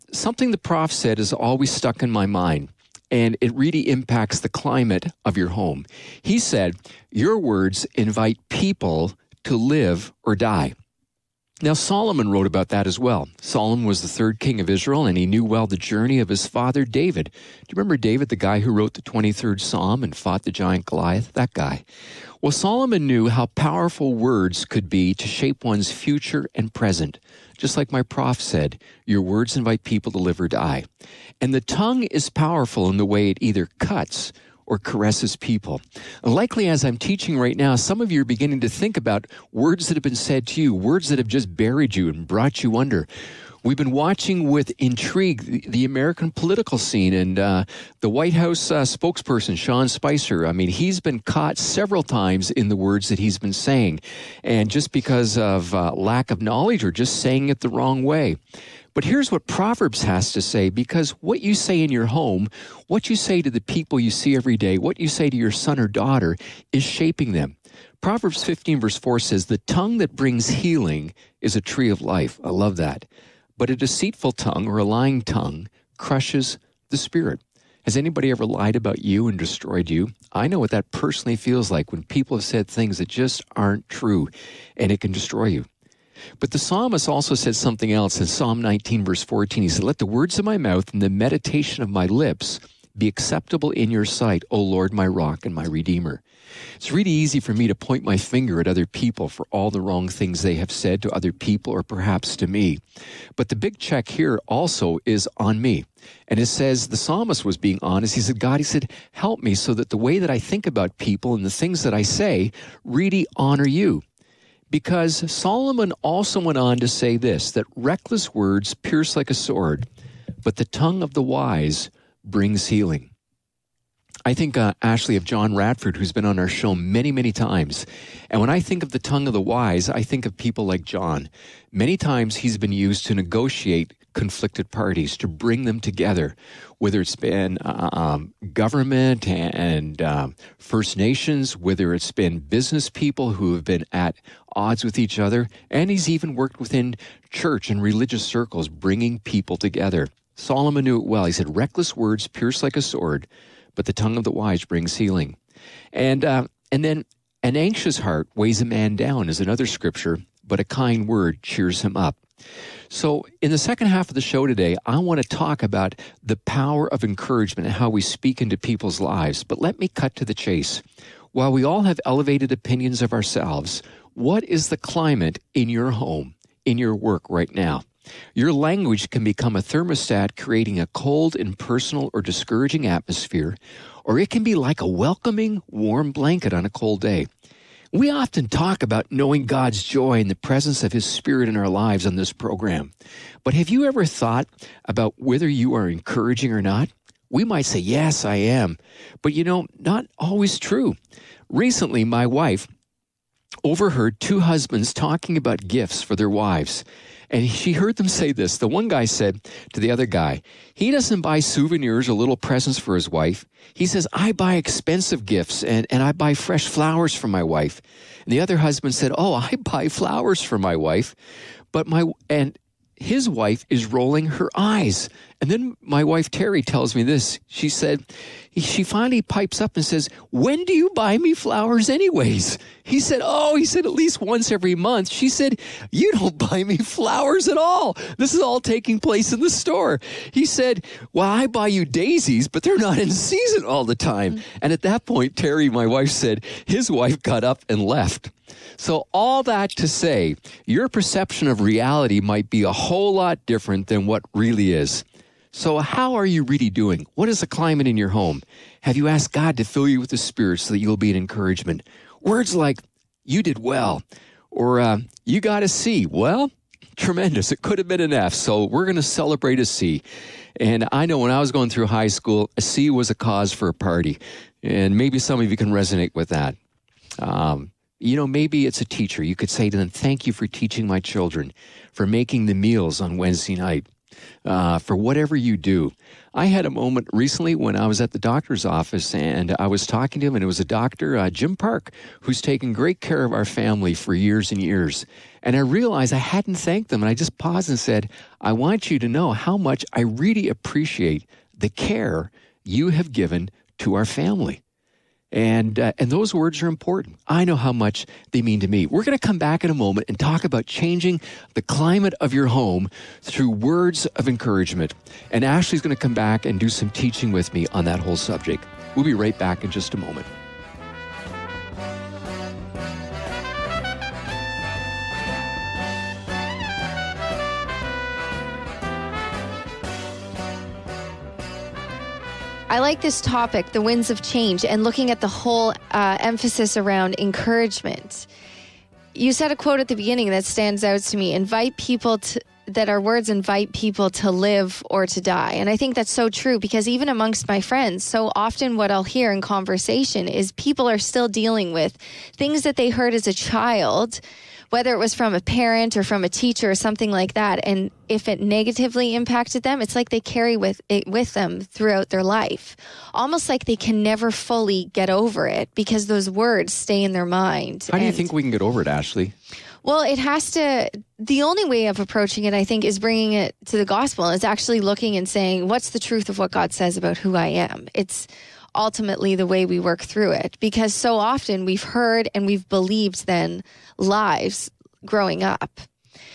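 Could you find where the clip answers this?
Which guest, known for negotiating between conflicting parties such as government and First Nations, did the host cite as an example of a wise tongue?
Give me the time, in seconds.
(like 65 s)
125 s.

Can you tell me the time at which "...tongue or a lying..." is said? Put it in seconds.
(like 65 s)
74 s.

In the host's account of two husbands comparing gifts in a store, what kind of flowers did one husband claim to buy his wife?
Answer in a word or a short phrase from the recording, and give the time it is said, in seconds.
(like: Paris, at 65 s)
Daisies, at 241 s.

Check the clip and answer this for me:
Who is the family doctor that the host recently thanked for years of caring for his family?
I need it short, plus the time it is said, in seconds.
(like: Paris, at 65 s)
Jim Park, at 291 s.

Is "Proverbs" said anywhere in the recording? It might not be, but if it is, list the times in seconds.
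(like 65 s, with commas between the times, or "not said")
59 s, 68 s.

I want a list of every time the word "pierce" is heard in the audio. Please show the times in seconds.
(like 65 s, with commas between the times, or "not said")
118 s, 152 s.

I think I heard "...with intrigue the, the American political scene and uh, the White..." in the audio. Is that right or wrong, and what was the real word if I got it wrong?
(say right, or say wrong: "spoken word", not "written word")
right.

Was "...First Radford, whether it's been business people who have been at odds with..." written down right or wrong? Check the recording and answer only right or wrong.
wrong.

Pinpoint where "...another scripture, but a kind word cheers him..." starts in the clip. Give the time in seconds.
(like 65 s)
159 s.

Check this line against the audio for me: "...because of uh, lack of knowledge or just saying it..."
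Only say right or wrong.
right.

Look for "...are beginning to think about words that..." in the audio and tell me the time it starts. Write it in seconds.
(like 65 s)
38 s.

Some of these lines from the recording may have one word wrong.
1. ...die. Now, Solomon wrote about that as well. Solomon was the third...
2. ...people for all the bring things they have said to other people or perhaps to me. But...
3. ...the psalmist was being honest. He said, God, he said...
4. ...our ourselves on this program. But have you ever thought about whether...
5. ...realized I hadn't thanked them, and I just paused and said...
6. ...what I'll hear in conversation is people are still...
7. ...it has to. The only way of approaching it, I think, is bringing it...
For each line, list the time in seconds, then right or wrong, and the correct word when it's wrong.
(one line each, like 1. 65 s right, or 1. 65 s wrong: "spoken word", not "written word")
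1. 10 s right
2. 98 s wrong: "wrong", not "bring"
3. 106 s right
4. 191 s wrong: "lives", not "ourselves"
5. 295 s right
6. 348 s right
7. 370 s right.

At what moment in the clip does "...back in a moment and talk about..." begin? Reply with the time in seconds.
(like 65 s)
309 s.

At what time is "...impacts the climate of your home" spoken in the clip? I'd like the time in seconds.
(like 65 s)
3 s.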